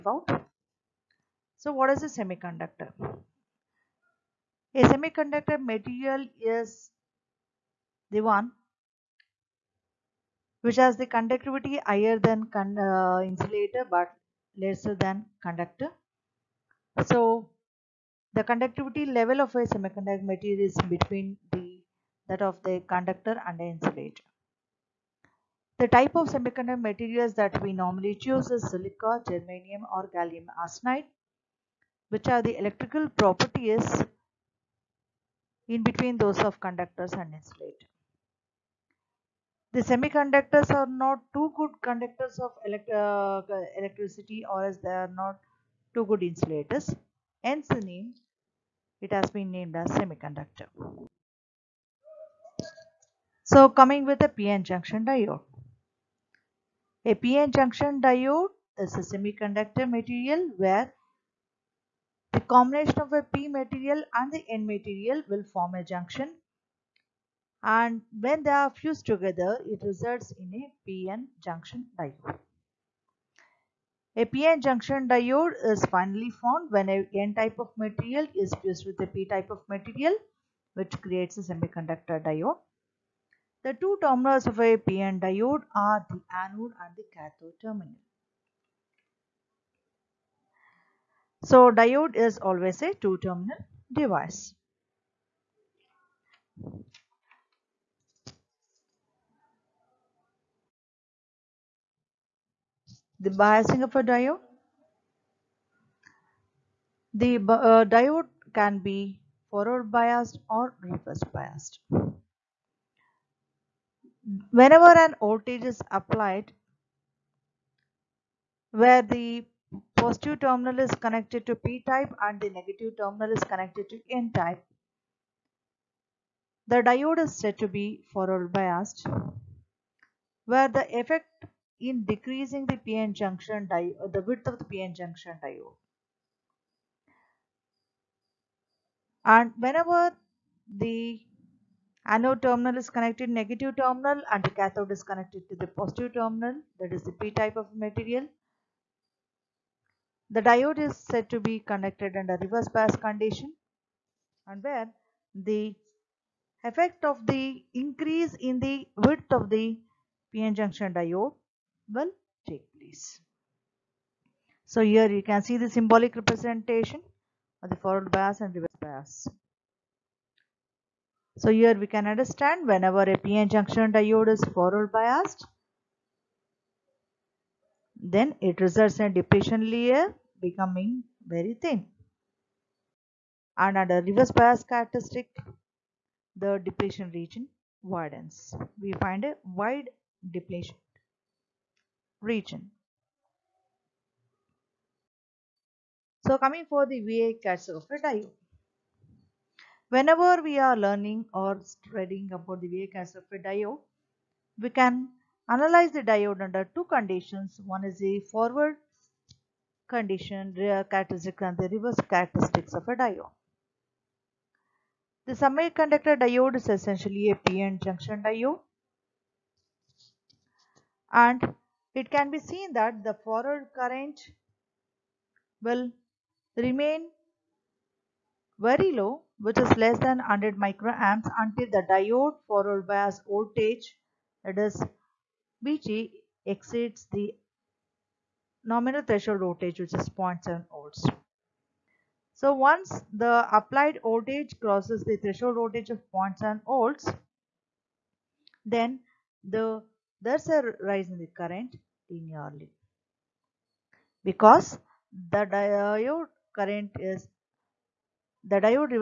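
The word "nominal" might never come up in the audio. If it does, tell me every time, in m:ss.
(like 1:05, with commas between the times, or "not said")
3:58.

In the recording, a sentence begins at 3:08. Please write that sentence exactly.
We find a wide depletion region.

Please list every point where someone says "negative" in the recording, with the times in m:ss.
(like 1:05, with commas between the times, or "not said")
2:02, 2:23.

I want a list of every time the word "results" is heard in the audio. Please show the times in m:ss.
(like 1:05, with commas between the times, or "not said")
1:09, 2:58.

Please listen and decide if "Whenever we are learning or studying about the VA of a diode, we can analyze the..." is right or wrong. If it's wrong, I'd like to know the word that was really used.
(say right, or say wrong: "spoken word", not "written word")
right.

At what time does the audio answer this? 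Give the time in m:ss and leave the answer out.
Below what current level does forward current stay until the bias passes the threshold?
3:50.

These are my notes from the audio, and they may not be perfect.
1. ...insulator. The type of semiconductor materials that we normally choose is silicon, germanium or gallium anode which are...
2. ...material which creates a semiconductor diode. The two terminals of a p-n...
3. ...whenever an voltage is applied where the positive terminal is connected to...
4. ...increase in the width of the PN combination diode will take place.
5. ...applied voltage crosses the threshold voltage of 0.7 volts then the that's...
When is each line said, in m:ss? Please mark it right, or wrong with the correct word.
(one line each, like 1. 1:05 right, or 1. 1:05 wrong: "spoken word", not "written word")
1. 0:23 wrong: "arsenide", not "anode"
2. 1:19 right
3. 1:54 right
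4. 2:37 wrong: "junction", not "combination"
5. 4:03 right.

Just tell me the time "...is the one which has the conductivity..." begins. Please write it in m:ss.
0:06.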